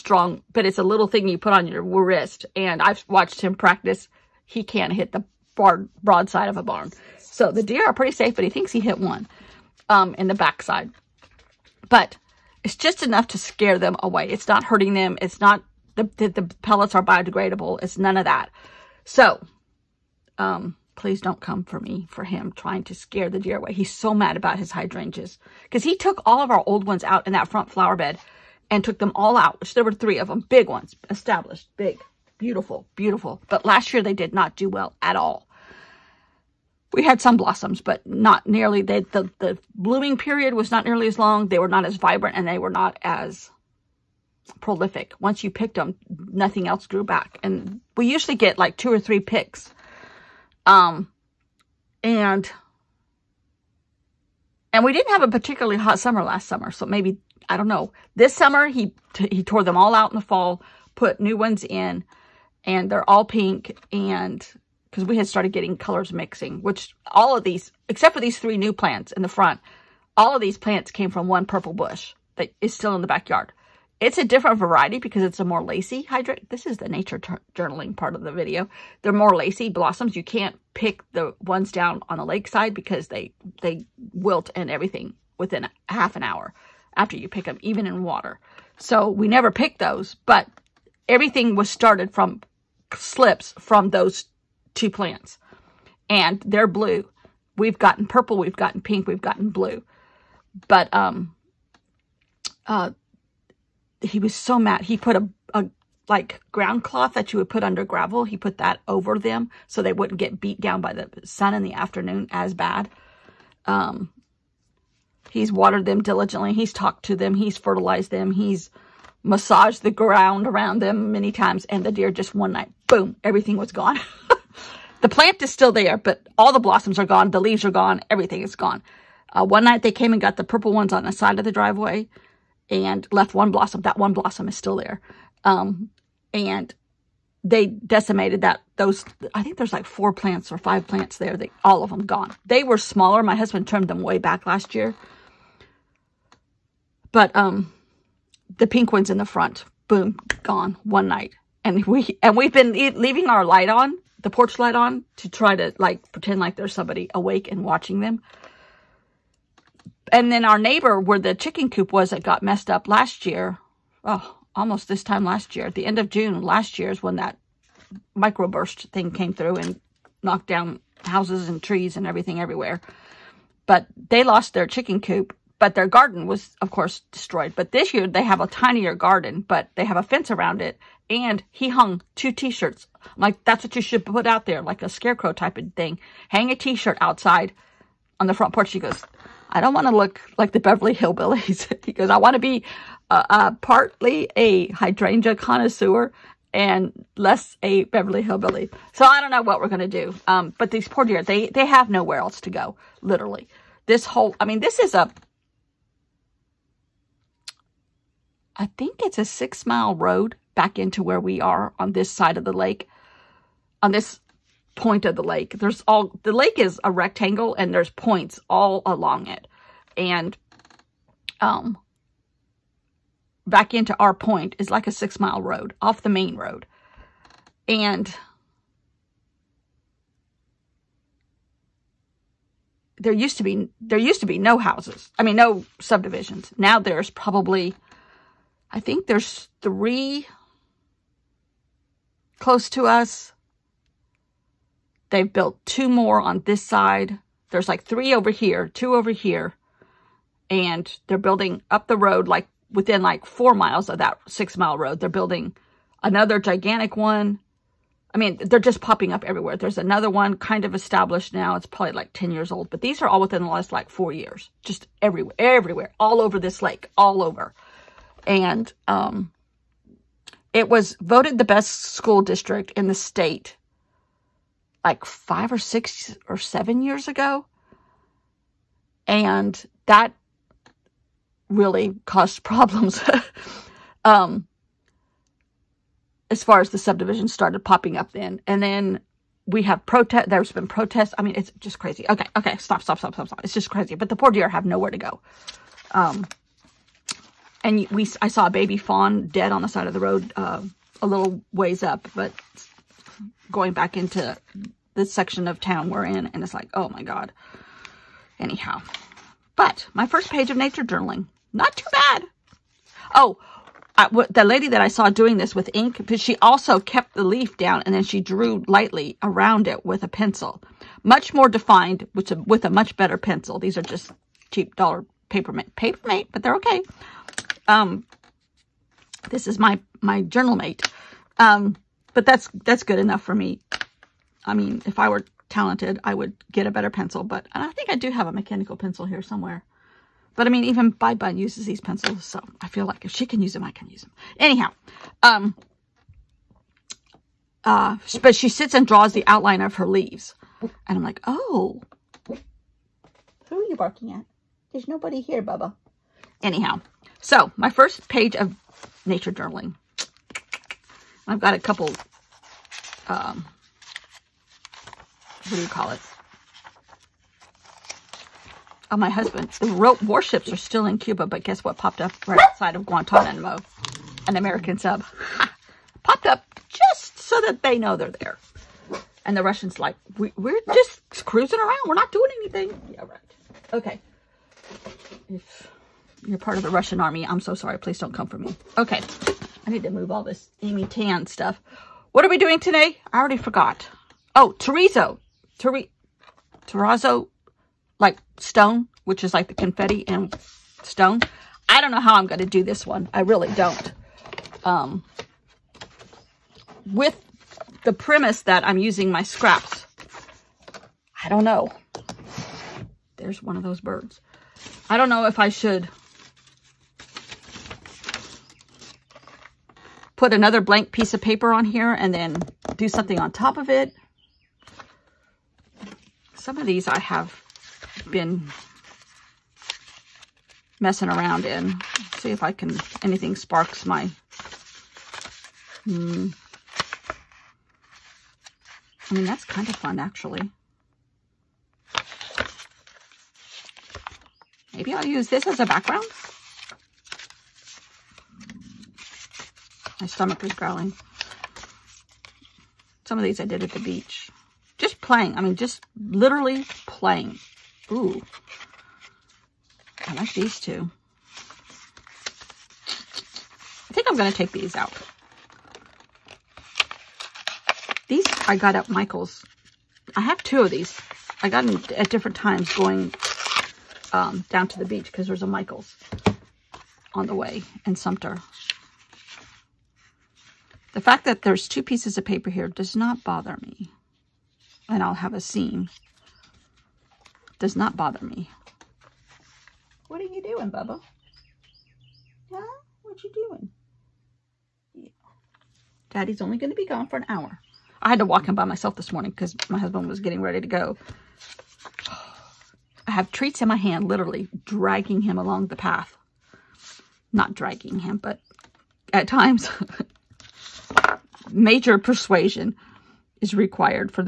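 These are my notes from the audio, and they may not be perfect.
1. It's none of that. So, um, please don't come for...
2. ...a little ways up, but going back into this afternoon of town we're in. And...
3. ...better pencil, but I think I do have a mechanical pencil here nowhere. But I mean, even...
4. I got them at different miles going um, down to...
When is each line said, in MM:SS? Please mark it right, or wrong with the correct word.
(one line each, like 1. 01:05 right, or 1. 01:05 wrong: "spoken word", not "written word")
1. 00:17 right
2. 05:01 wrong: "section", not "afternoon"
3. 05:36 wrong: "somewhere", not "nowhere"
4. 07:51 wrong: "times", not "miles".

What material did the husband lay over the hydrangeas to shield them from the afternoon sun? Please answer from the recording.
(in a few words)
ground cloth.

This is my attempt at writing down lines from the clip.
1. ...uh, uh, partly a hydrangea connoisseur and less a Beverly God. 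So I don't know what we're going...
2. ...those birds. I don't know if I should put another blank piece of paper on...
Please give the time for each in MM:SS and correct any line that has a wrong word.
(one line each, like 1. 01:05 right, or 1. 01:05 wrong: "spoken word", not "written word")
1. 03:13 wrong: "Hillbilly", not "God"
2. 06:53 right.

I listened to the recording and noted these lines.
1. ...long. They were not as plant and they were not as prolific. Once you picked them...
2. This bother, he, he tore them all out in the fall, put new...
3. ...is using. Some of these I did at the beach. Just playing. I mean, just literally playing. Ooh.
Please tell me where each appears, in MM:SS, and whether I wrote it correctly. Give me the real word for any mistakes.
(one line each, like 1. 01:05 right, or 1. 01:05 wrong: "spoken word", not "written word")
1. 00:41 wrong: "vibrant", not "plant"
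2. 00:58 wrong: "summer", not "bother"
3. 07:30 wrong: "growling", not "using".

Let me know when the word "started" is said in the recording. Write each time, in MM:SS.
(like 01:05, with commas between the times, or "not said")
01:05, 01:31, 04:47.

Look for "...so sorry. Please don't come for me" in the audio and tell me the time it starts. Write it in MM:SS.
06:27.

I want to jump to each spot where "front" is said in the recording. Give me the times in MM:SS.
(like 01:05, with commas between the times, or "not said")
00:27, 01:09, 02:29, 03:08.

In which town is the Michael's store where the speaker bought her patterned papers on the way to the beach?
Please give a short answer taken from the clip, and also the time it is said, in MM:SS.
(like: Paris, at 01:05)
Sumter, at 07:57.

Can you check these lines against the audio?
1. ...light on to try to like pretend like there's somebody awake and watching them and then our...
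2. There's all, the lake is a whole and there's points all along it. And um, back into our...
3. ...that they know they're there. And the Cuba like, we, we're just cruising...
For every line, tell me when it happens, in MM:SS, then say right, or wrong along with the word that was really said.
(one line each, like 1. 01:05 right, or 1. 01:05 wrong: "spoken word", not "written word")
1. 02:34 right
2. 03:35 wrong: "rectangle", not "whole"
3. 06:17 wrong: "Russians", not "Cuba".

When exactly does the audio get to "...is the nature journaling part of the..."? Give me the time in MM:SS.
01:16.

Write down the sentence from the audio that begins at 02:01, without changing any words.
And the deer just one night, boom, everything was gone.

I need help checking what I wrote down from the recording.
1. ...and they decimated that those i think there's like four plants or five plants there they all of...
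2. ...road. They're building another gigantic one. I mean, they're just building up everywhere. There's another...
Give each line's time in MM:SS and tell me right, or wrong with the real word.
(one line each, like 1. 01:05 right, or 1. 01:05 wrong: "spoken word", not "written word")
1. 02:16 right
2. 04:14 wrong: "popping", not "building".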